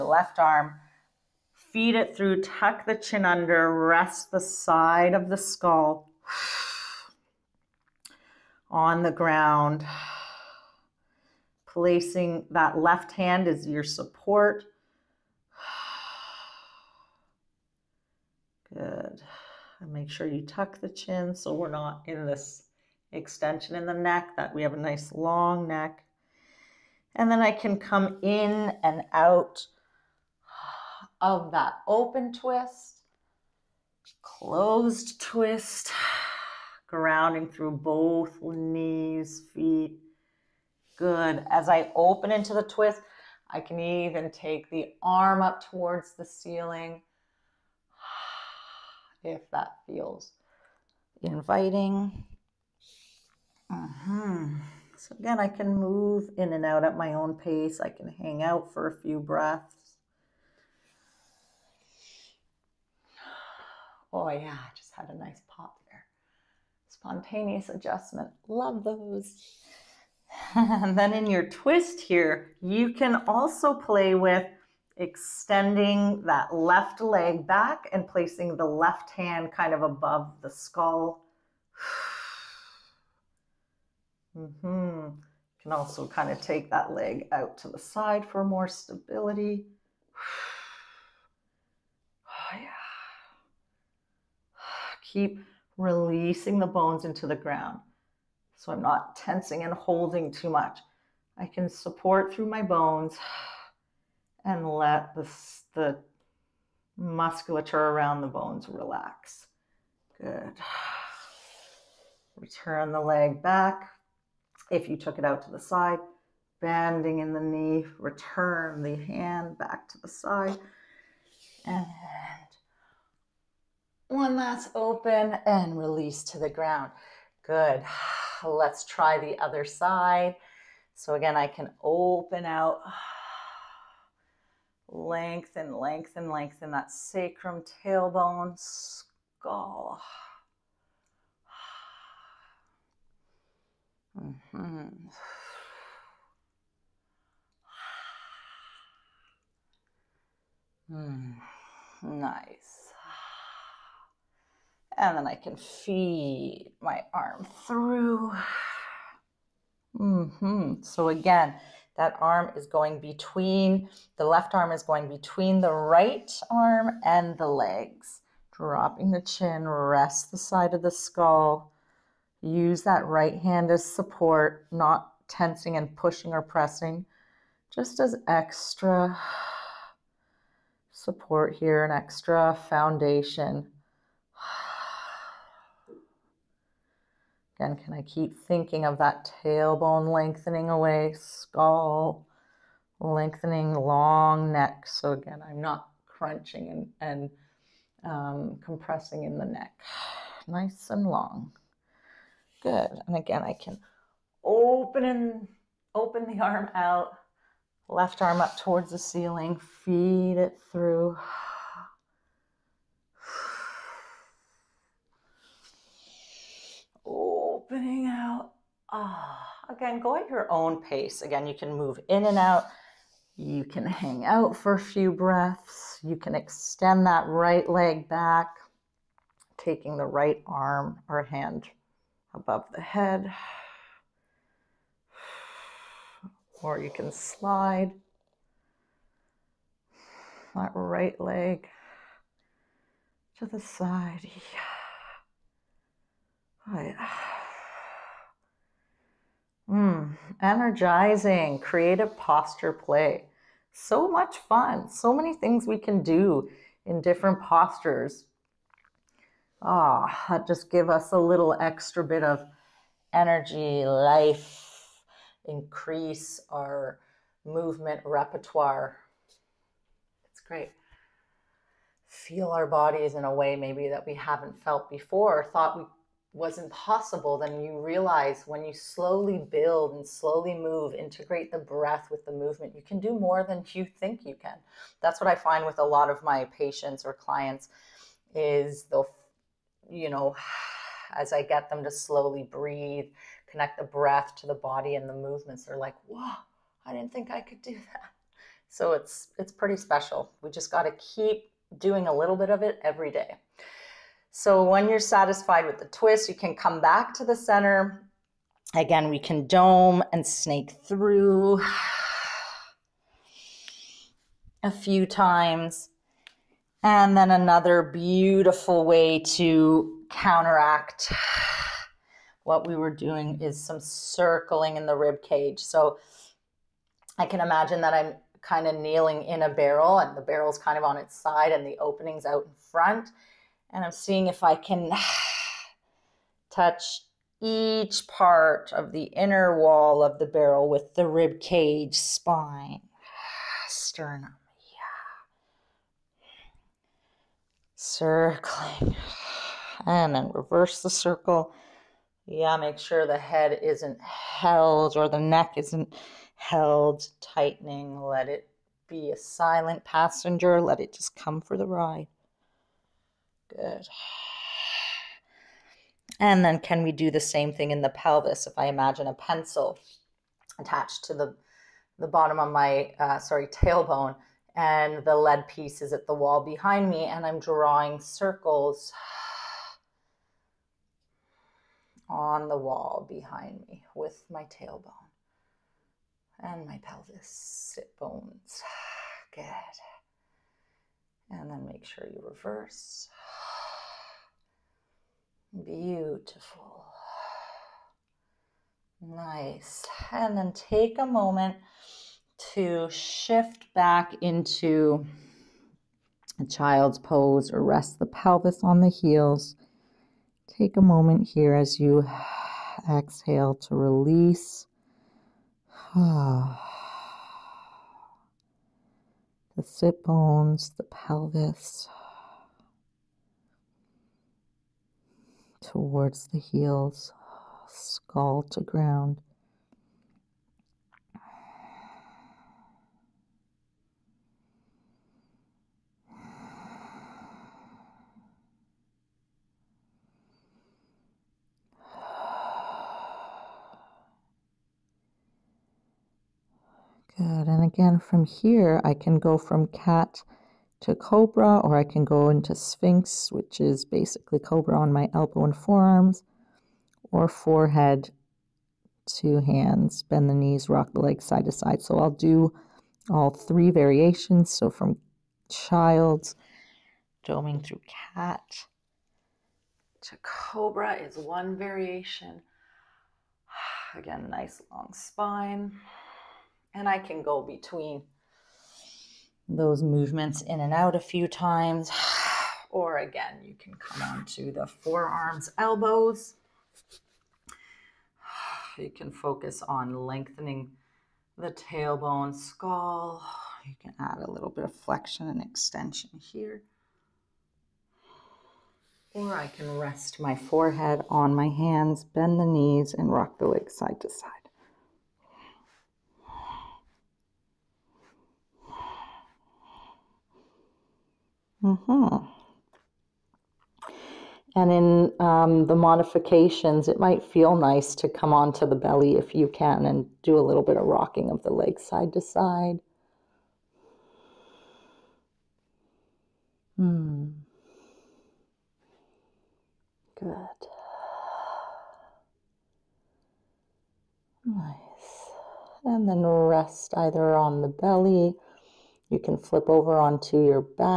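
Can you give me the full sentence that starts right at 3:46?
You can extend that right leg back, taking the right arm or hand above the head.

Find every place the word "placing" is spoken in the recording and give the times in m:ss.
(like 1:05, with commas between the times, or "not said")
0:11, 1:18.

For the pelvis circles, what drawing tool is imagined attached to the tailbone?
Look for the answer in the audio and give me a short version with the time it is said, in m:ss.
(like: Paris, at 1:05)
A pencil, at 6:09.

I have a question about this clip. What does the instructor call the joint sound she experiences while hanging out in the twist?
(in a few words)
Spontaneous adjustment.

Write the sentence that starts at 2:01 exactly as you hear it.
And one last open and release to the ground.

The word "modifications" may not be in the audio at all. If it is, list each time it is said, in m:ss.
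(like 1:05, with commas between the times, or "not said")
8:35.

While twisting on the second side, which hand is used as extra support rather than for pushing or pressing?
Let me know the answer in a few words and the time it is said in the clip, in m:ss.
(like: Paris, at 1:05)
Right hand, at 2:53.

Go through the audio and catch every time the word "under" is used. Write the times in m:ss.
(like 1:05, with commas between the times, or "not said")
0:03.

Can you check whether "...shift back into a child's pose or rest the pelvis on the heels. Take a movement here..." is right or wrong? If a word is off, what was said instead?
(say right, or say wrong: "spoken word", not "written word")
wrong: "moment", not "movement".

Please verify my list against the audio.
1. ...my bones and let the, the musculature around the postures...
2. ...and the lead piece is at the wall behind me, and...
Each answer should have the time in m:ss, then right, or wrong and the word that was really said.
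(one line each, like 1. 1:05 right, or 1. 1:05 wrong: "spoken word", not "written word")
1. 1:42 wrong: "bones", not "postures"
2. 6:14 right.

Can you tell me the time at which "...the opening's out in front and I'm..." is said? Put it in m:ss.
5:31.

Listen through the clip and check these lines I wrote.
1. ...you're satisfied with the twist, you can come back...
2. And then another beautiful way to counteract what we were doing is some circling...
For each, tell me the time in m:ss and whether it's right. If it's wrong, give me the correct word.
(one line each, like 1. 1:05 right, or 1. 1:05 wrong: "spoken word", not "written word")
1. 5:04 right
2. 5:16 right.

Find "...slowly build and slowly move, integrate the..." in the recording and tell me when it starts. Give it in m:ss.
4:38.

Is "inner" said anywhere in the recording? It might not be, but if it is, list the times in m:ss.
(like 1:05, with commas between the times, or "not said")
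5:39.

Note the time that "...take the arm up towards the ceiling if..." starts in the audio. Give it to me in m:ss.
0:44.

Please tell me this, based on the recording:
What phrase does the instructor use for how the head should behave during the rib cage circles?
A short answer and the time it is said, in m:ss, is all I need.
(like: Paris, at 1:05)
Silent passenger, at 5:59.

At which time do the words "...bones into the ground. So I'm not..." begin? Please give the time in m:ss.
1:36.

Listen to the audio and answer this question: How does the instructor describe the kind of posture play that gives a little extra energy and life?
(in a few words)
Energizing, creative.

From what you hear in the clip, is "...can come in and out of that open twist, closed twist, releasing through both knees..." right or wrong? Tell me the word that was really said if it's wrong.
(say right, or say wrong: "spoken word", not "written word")
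wrong: "grounding", not "releasing".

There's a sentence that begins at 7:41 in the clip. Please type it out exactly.
So I'll do all three variations.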